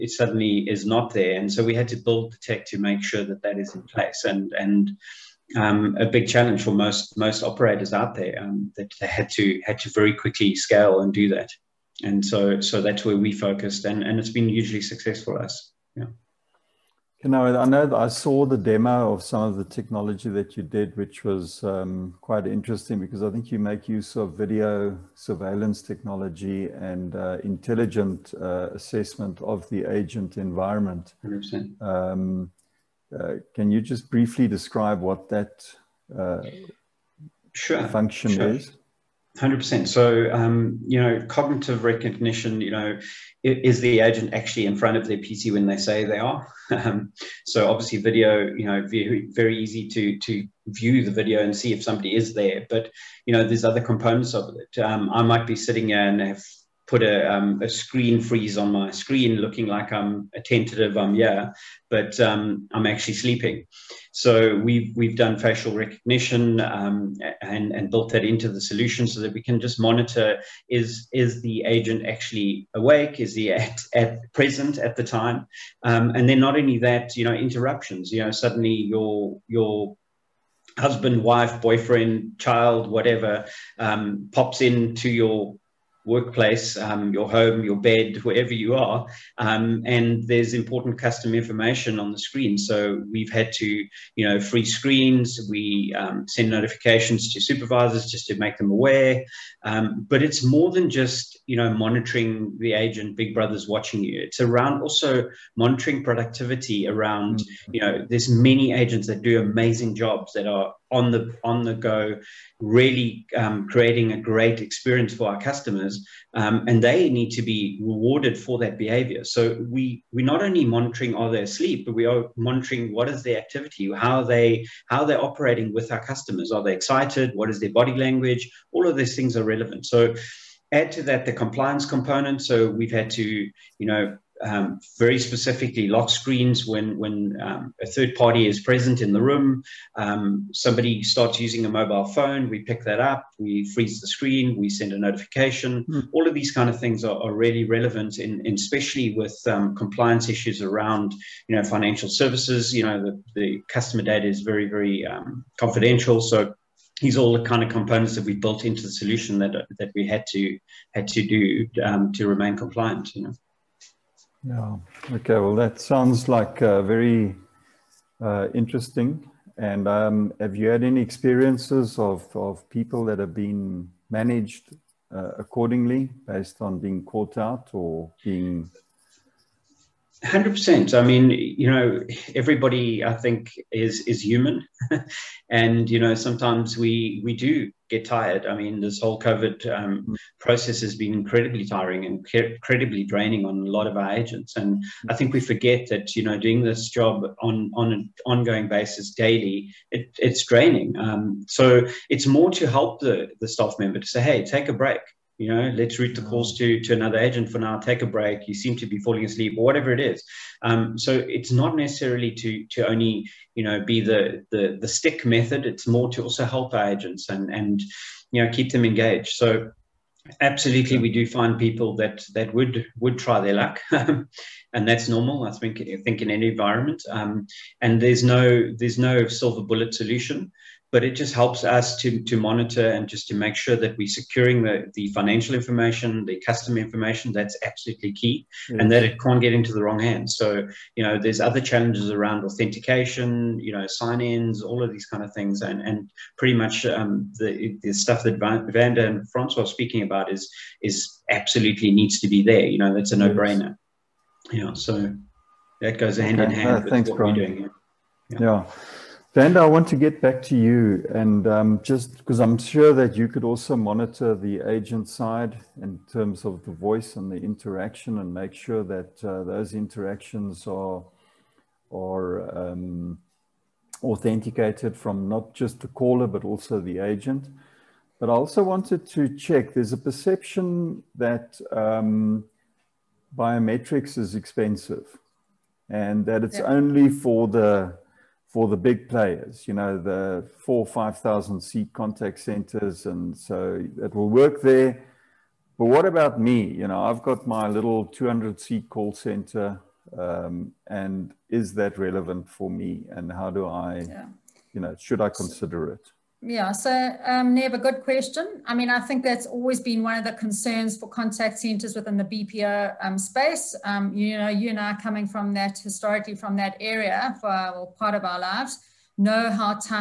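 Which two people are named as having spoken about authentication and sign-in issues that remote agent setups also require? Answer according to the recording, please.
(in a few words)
Vanda and Francois.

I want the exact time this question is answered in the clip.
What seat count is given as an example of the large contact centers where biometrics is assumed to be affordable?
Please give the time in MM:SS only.
04:50.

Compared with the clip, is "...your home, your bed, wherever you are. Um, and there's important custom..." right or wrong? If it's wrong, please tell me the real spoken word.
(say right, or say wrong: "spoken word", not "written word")
right.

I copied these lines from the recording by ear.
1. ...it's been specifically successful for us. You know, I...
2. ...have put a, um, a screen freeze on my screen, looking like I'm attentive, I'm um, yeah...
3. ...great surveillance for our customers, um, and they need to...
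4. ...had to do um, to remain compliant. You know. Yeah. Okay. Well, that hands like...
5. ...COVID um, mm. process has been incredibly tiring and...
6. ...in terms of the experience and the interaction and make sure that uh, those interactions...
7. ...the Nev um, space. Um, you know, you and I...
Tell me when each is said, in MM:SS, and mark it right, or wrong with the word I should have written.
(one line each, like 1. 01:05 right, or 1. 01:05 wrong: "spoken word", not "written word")
1. 00:14 wrong: "hugely", not "specifically"
2. 00:56 right
3. 01:54 wrong: "experience", not "surveillance"
4. 02:40 wrong: "sounds", not "hands"
5. 03:09 right
6. 04:25 wrong: "voice", not "experience"
7. 05:12 wrong: "BPO", not "Nev".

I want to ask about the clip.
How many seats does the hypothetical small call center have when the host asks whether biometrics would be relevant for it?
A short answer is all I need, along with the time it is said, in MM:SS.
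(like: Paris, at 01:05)
200, at 04:58.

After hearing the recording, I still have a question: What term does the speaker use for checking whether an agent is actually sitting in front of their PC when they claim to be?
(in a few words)
cognitive recognition.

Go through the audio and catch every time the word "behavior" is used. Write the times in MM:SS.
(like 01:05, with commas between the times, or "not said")
01:58.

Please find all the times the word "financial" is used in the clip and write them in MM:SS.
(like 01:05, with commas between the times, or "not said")
02:31, 03:55.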